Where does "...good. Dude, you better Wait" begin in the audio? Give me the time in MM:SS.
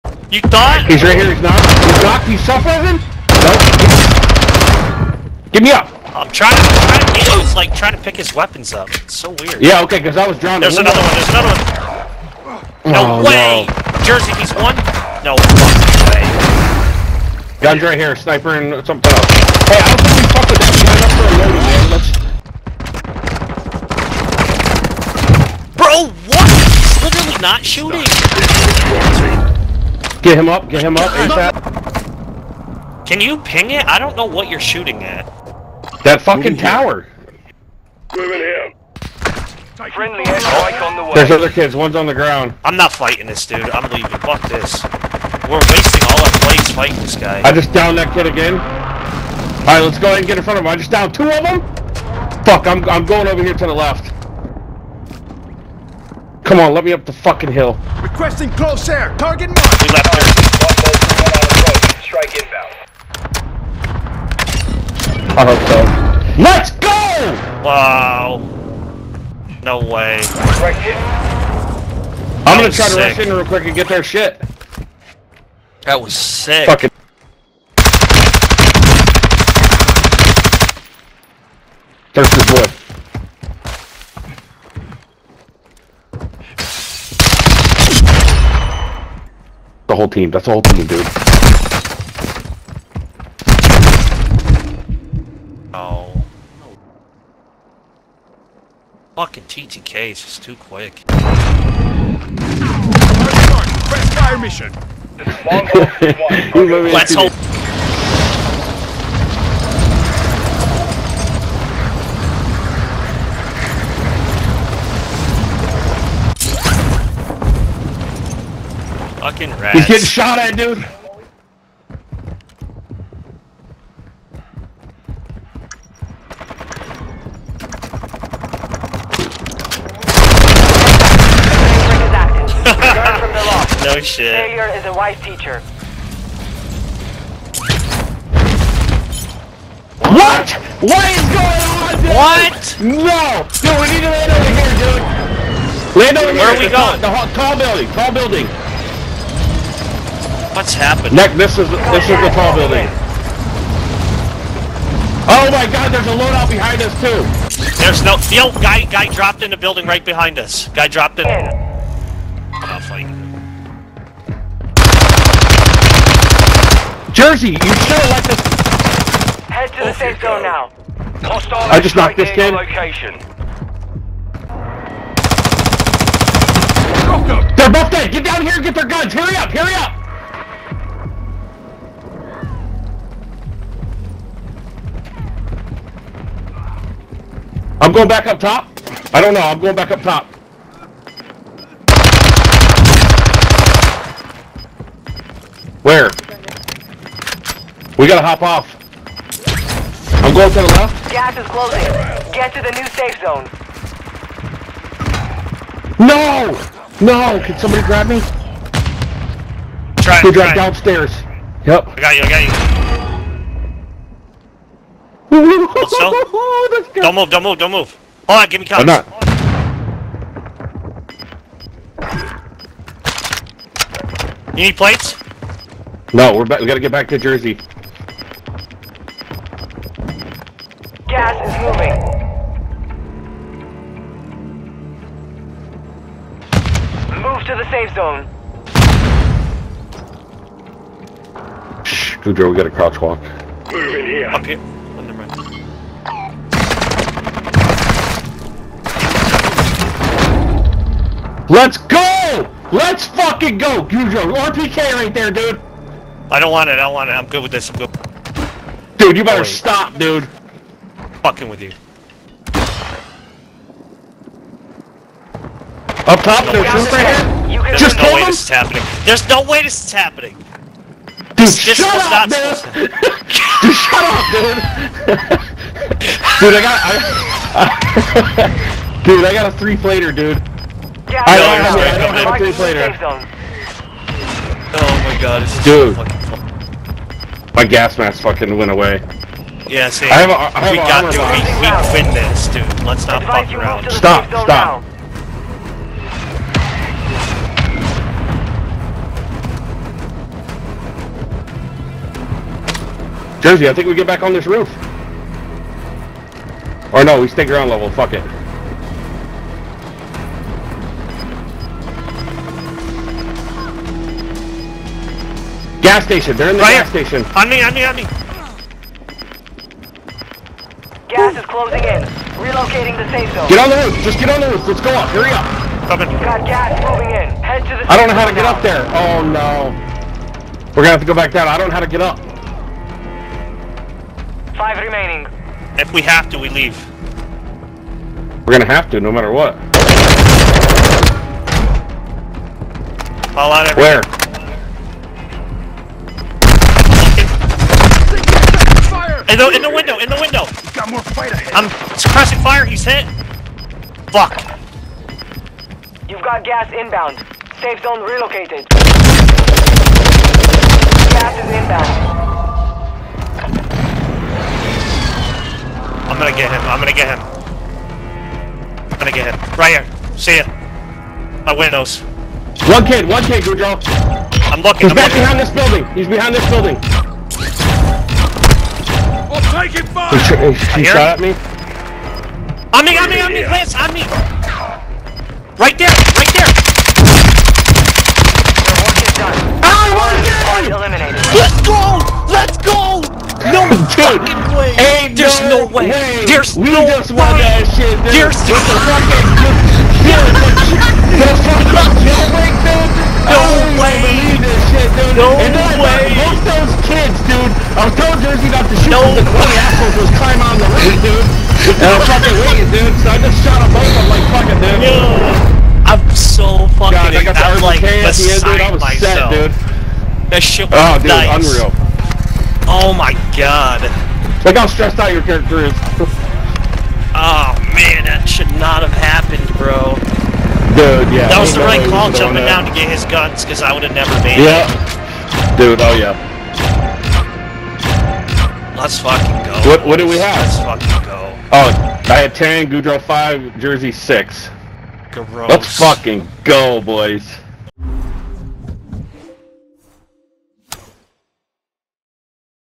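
04:17.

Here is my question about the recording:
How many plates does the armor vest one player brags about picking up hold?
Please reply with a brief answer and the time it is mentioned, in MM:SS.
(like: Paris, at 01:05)
3, at 04:39.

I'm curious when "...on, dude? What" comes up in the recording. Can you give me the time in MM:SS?
02:21.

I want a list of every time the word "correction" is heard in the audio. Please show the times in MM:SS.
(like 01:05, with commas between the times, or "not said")
not said.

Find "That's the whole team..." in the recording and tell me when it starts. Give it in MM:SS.
01:30.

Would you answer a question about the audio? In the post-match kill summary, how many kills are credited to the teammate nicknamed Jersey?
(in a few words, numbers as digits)
6.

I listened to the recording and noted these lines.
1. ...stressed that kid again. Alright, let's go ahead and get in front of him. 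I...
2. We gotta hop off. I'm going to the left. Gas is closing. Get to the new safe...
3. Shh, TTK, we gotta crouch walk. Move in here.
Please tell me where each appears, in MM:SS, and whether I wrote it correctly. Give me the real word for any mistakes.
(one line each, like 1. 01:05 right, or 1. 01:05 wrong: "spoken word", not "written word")
1. 00:47 wrong: "downed", not "stressed"
2. 03:17 right
3. 04:01 wrong: "Goudreau", not "TTK".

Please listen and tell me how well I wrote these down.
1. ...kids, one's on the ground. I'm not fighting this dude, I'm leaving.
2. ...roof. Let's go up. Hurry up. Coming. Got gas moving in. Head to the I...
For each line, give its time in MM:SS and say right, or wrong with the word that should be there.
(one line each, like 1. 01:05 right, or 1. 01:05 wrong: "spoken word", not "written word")
1. 00:41 right
2. 05:24 right.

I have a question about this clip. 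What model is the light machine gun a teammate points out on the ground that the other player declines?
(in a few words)
RPK.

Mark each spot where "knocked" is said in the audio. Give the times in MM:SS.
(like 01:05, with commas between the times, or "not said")
00:01, 02:51.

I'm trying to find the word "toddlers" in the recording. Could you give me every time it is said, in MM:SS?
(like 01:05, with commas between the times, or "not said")
not said.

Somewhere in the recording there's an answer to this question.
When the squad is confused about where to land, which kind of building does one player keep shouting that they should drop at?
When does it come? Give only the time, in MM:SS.
02:27.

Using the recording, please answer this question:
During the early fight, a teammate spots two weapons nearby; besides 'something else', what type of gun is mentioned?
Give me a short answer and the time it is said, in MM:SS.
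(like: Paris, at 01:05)
Sniper, at 00:18.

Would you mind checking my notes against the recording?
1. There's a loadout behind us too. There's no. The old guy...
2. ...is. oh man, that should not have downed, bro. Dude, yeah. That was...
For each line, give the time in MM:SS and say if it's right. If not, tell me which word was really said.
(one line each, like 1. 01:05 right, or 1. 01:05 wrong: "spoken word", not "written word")
1. 02:35 right
2. 07:05 wrong: "happened", not "downed".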